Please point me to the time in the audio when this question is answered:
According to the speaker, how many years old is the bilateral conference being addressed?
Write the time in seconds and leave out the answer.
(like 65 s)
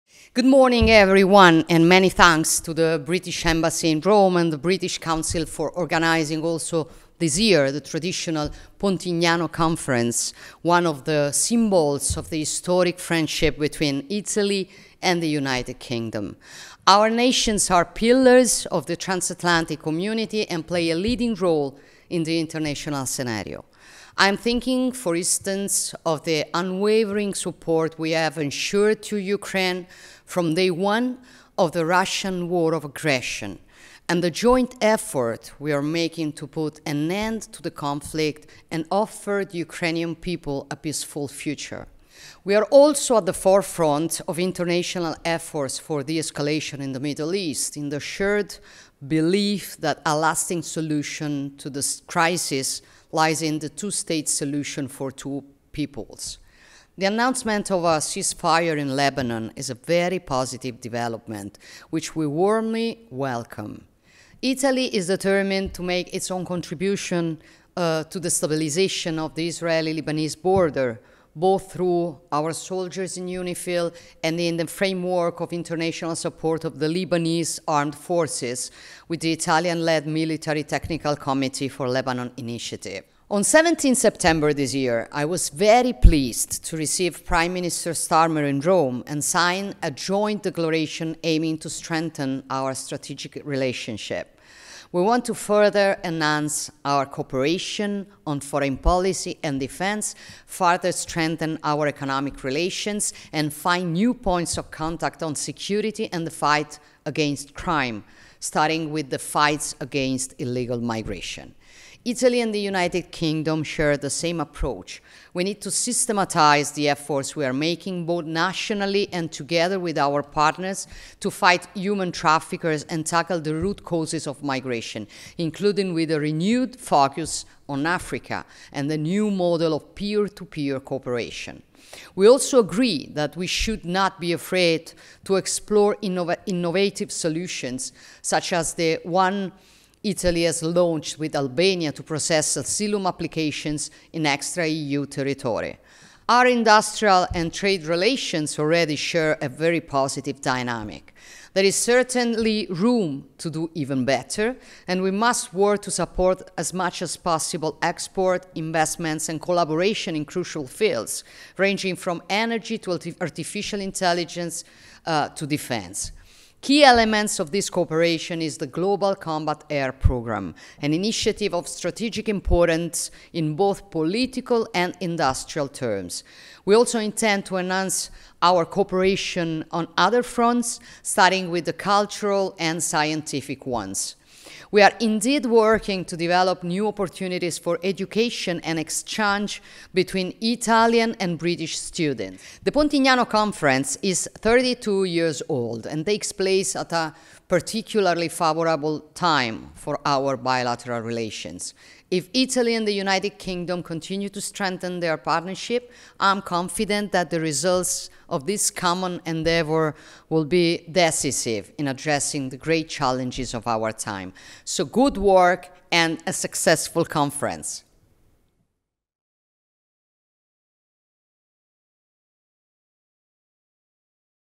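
194 s.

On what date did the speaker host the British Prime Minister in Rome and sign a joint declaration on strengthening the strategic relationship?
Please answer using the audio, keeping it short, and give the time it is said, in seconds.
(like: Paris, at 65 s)
17 September, at 83 s.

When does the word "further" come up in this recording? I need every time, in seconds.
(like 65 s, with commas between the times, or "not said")
95 s, 100 s.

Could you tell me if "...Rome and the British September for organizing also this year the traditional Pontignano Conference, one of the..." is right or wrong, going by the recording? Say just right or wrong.
wrong.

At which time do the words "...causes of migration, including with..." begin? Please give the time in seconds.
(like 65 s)
123 s.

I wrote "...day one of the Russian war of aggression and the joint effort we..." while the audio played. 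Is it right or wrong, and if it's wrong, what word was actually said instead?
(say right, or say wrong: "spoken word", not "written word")
right.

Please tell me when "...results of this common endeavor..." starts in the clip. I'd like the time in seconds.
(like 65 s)
207 s.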